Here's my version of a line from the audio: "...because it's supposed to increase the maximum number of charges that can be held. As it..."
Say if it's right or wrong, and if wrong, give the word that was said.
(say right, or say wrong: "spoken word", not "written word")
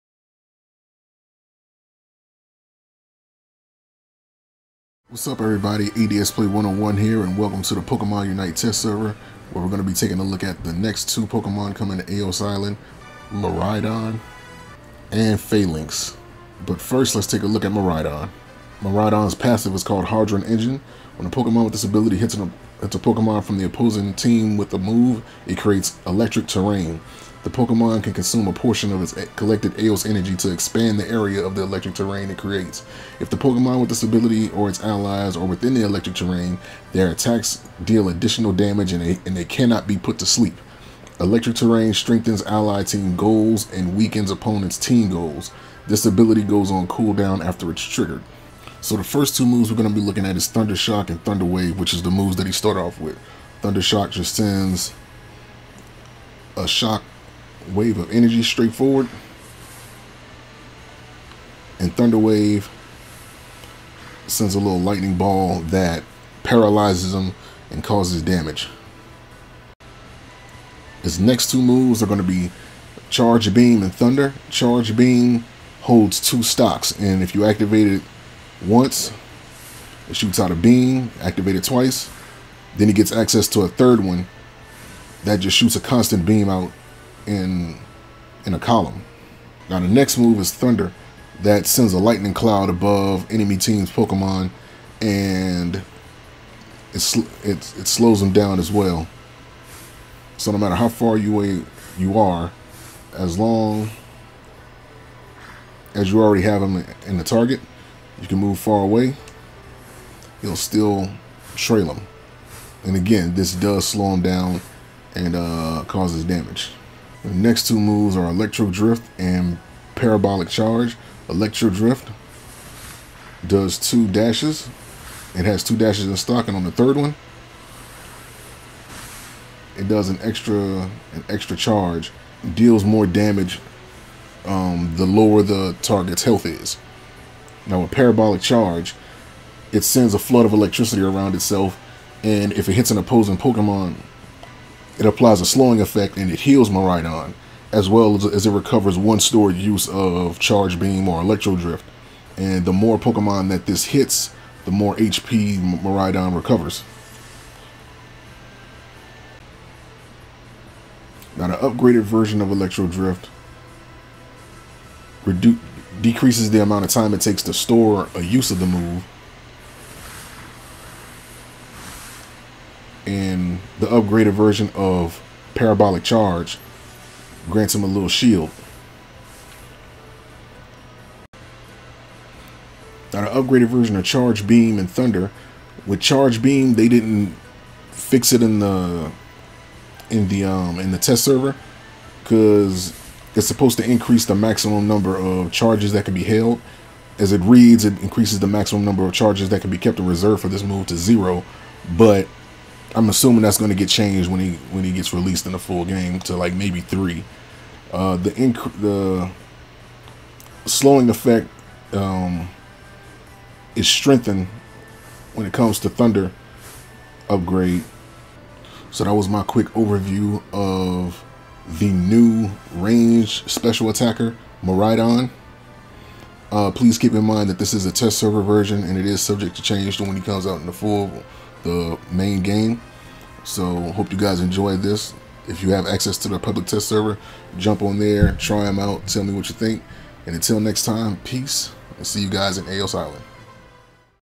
right.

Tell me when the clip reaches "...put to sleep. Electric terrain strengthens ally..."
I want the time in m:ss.
0:39.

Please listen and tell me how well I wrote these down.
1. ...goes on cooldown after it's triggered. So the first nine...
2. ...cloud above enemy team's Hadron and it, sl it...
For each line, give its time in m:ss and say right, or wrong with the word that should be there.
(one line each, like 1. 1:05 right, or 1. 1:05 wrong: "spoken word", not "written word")
1. 0:46 wrong: "two", not "nine"
2. 1:32 wrong: "Pokemon", not "Hadron".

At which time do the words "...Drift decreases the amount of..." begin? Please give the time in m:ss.
2:42.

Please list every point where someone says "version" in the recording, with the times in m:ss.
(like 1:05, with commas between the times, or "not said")
2:42, 2:54, 3:03, 3:48.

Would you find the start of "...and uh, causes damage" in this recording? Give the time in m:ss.
1:55.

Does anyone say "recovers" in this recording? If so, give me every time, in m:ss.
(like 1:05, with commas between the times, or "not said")
2:28, 2:36.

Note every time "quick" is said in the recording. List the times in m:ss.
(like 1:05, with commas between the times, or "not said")
3:39.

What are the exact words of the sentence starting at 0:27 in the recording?
The Pokemon can consume a portion of its collected Aeos energy to expand the area of the electric terrain it creates.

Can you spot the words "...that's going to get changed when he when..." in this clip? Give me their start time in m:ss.
3:23.